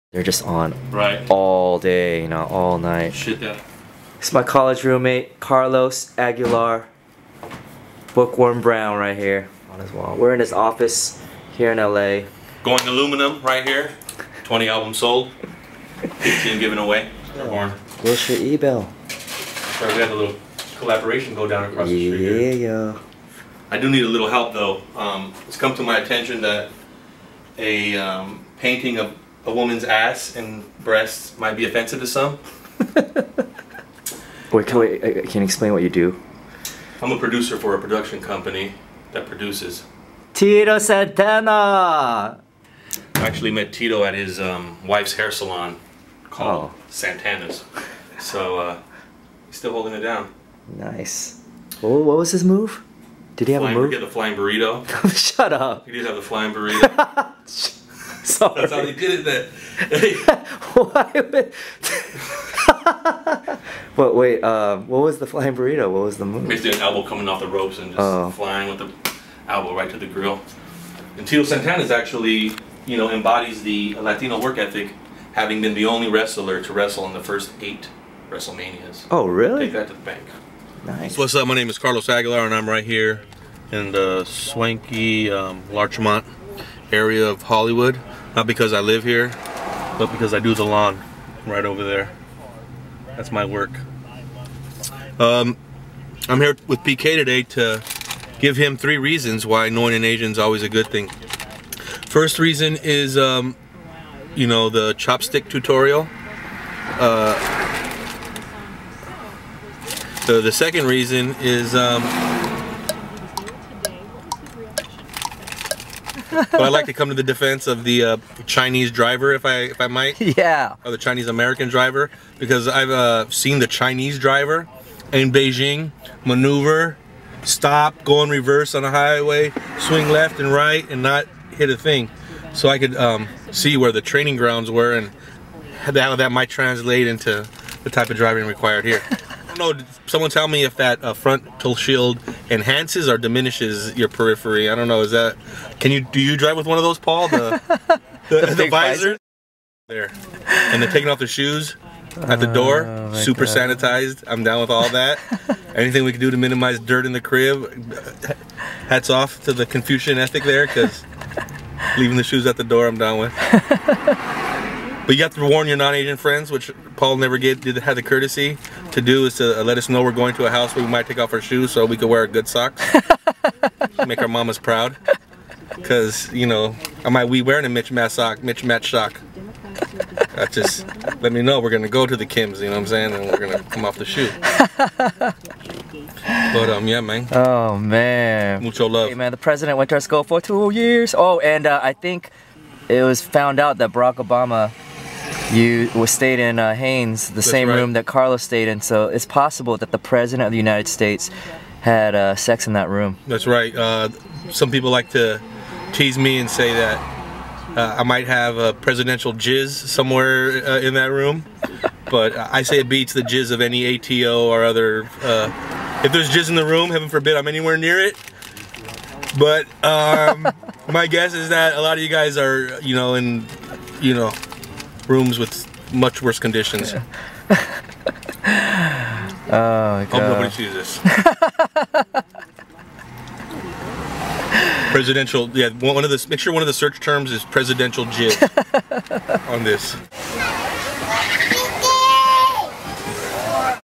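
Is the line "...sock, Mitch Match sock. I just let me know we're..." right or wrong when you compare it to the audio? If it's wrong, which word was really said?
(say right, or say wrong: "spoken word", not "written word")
right.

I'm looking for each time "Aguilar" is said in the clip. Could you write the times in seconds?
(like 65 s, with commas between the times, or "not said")
6 s, 82 s.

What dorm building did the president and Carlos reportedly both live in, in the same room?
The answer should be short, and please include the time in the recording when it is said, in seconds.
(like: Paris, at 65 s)
Haines, at 196 s.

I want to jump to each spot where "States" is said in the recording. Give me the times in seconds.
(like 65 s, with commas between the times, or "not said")
200 s.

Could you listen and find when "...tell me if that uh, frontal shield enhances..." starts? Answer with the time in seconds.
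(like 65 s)
140 s.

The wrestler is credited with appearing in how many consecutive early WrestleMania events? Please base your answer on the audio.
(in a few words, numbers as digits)
8.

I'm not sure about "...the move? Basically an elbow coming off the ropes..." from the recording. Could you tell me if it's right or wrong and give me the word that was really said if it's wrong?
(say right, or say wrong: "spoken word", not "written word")
right.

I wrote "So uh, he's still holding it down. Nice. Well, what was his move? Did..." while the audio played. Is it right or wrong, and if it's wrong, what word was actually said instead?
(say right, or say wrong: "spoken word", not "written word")
right.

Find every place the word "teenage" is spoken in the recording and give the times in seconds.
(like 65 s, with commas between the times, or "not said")
not said.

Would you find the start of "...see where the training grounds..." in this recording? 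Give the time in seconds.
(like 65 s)
133 s.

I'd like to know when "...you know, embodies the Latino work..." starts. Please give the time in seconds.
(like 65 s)
72 s.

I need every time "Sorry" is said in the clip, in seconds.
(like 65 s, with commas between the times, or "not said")
19 s, 58 s.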